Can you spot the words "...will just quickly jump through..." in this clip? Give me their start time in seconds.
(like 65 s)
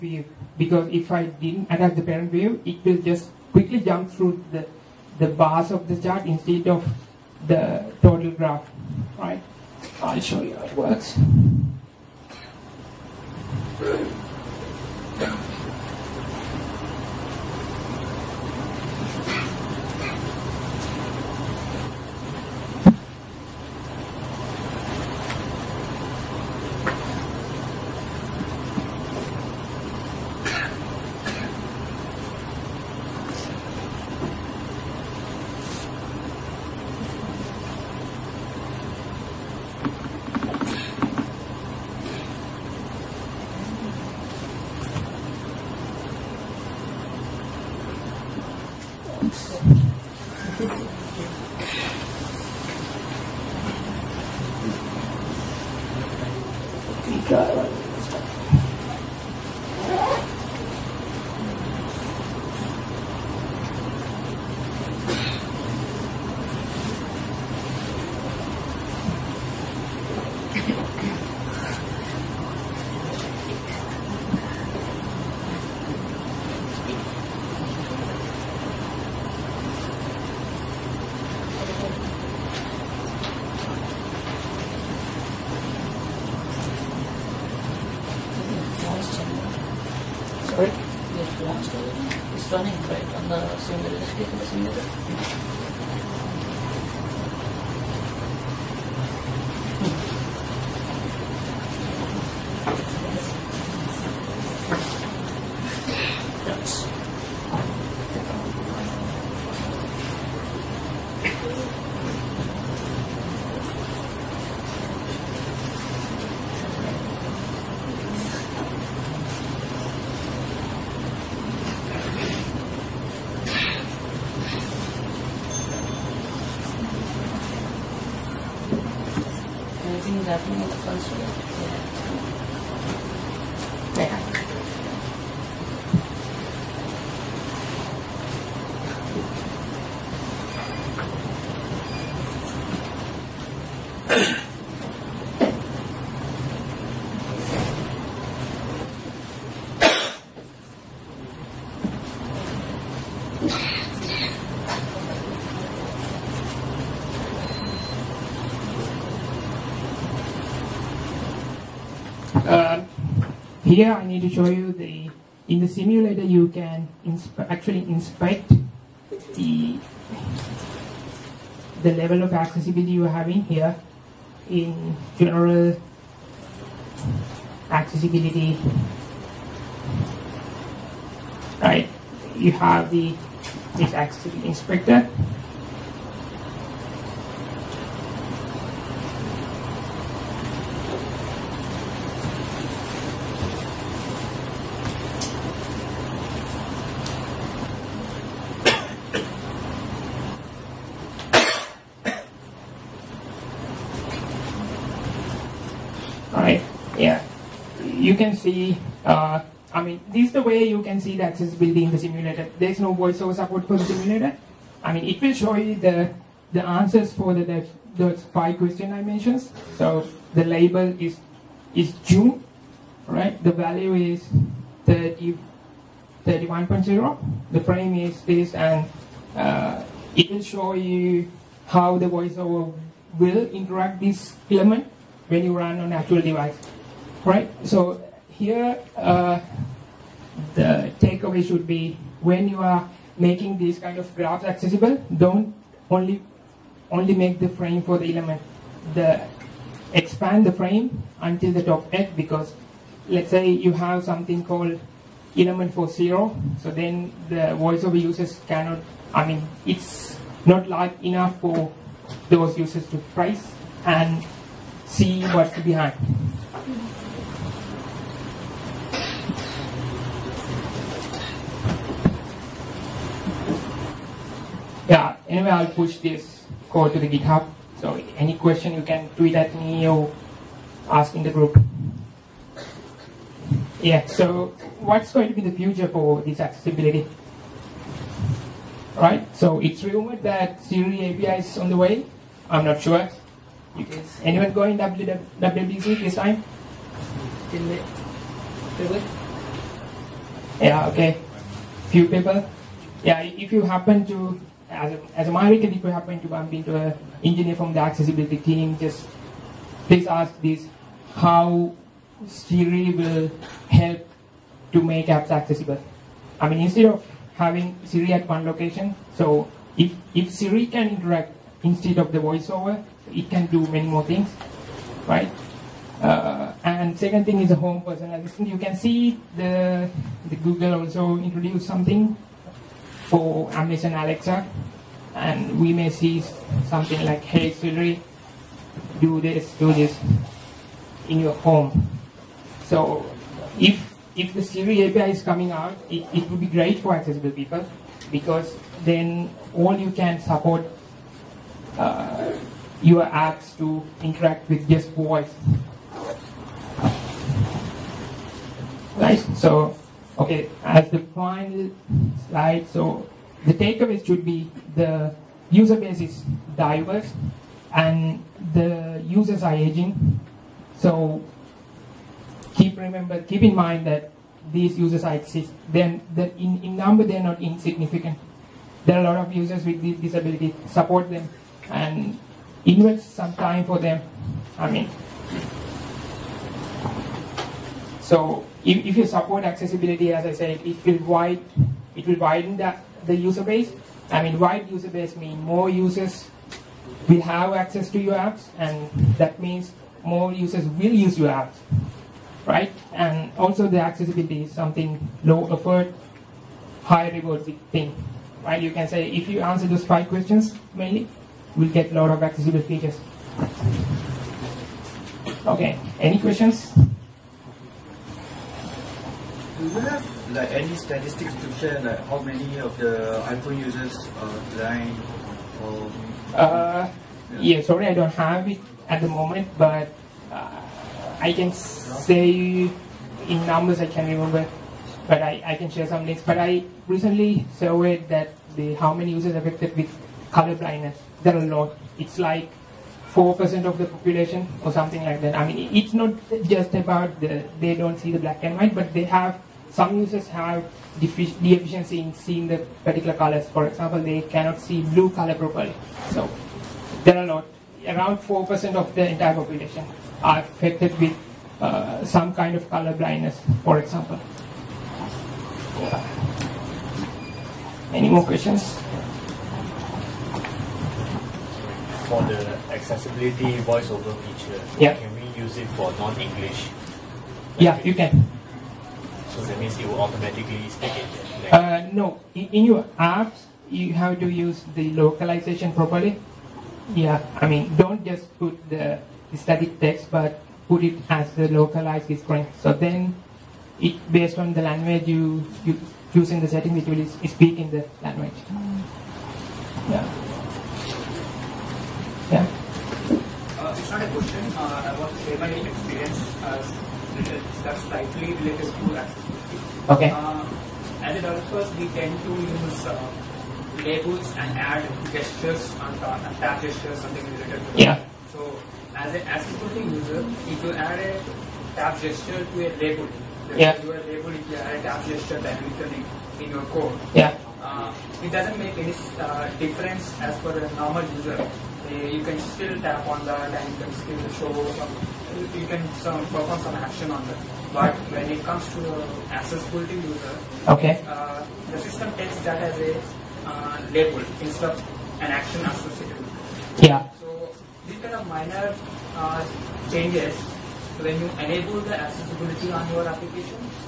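2 s.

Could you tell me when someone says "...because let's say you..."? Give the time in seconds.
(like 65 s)
252 s.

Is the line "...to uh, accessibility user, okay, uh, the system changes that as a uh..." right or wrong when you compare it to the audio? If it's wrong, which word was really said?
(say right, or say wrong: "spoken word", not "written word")
wrong: "takes", not "changes".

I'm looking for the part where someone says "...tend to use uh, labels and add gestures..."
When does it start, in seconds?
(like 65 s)
511 s.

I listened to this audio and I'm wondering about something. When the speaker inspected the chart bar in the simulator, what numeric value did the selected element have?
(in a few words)
31.0.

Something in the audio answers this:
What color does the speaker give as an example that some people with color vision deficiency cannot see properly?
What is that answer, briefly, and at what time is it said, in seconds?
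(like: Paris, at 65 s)
blue, at 454 s.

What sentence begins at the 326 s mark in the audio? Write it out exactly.
Uh, and second thing is a home personal assistant.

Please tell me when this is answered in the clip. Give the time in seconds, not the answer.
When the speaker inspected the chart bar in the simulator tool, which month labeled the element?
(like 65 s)
222 s.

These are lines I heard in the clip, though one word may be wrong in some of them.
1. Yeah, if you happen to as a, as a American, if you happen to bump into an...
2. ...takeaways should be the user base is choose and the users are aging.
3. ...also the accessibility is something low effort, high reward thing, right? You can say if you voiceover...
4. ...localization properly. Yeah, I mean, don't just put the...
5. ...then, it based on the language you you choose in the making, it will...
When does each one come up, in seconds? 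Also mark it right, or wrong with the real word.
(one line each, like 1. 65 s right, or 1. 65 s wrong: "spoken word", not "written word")
1. 303 s right
2. 363 s wrong: "diverse", not "choose"
3. 403 s wrong: "answer", not "voiceover"
4. 484 s right
5. 492 s wrong: "setting", not "making".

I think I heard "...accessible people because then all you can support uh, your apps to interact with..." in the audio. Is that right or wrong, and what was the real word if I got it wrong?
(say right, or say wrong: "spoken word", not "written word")
right.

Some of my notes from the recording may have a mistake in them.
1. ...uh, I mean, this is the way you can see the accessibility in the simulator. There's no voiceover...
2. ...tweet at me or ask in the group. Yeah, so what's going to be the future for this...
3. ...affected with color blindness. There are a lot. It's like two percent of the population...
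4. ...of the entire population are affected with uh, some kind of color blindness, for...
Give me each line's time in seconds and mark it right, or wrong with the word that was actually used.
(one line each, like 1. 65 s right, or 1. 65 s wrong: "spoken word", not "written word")
1. 209 s right
2. 279 s right
3. 439 s wrong: "four", not "two"
4. 458 s right.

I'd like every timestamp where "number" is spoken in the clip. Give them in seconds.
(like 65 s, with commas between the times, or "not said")
376 s, 433 s.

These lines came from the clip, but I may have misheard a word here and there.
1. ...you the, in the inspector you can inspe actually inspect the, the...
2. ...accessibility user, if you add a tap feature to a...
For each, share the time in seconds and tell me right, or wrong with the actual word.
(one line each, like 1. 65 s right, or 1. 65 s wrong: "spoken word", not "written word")
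1. 164 s wrong: "simulator", not "inspector"
2. 519 s wrong: "gesture", not "feature".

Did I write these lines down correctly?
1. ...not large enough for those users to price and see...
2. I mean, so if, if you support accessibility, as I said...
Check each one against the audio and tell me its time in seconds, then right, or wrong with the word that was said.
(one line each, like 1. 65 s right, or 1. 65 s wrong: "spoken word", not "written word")
1. 260 s right
2. 384 s right.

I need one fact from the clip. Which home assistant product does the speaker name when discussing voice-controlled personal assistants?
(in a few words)
Amazon Alexa.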